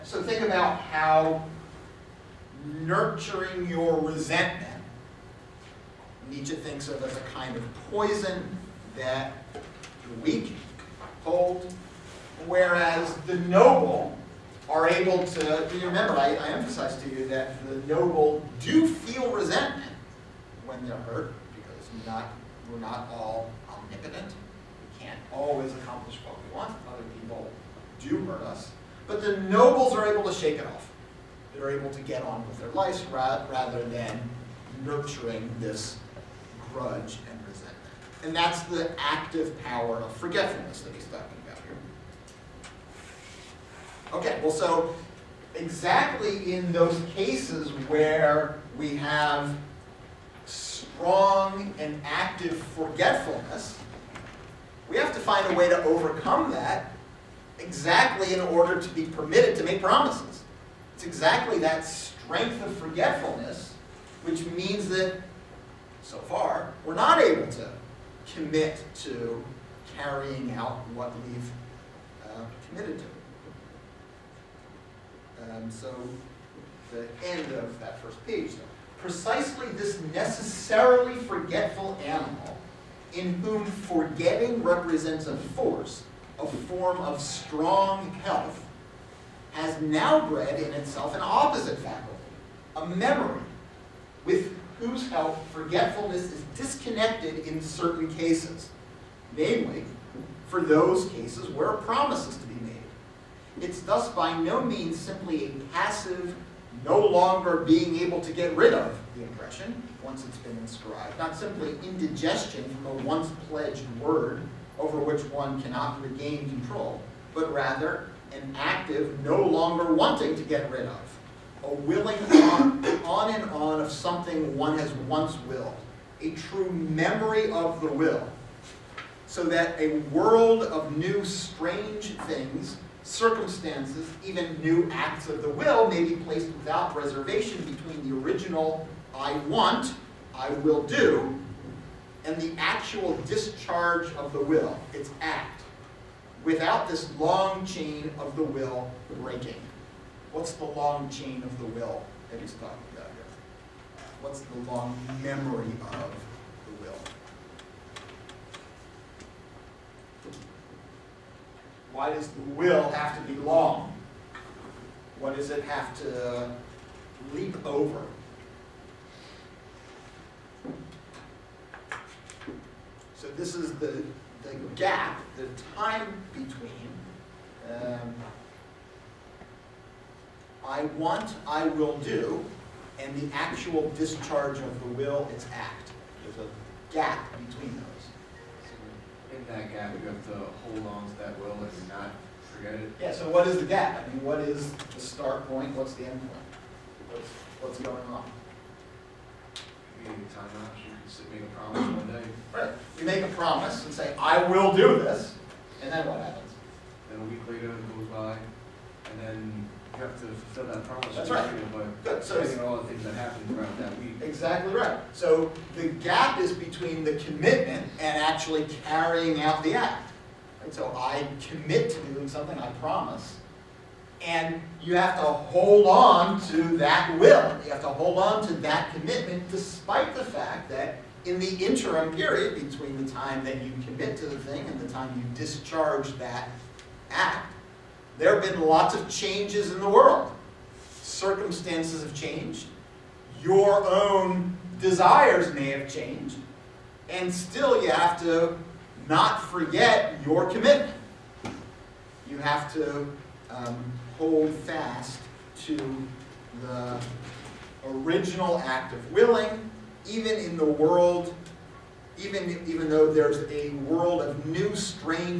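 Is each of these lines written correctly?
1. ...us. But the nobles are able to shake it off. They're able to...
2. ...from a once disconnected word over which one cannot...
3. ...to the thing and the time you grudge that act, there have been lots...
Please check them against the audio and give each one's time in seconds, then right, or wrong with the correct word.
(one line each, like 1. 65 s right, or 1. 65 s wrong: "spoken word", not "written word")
1. 28 s right
2. 112 s wrong: "pledged", not "disconnected"
3. 234 s wrong: "discharge", not "grudge".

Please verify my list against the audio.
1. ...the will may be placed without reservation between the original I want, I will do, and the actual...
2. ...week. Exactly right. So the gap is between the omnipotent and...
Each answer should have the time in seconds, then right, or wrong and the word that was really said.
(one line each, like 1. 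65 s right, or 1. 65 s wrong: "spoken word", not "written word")
1. 135 s right
2. 213 s wrong: "commitment", not "omnipotent".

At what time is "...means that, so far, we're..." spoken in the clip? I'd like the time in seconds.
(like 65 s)
64 s.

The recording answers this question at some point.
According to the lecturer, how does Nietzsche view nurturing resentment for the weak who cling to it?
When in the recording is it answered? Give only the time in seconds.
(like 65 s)
7 s.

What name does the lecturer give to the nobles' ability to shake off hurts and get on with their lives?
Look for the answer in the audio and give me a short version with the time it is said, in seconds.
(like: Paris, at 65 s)
Active power of forgetfulness, at 38 s.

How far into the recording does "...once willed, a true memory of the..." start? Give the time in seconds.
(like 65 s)
125 s.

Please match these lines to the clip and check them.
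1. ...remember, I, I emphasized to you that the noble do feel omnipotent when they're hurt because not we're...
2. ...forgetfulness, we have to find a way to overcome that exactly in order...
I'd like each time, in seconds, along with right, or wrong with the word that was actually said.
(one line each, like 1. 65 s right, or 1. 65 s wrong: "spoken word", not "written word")
1. 15 s wrong: "resentment", not "omnipotent"
2. 52 s right.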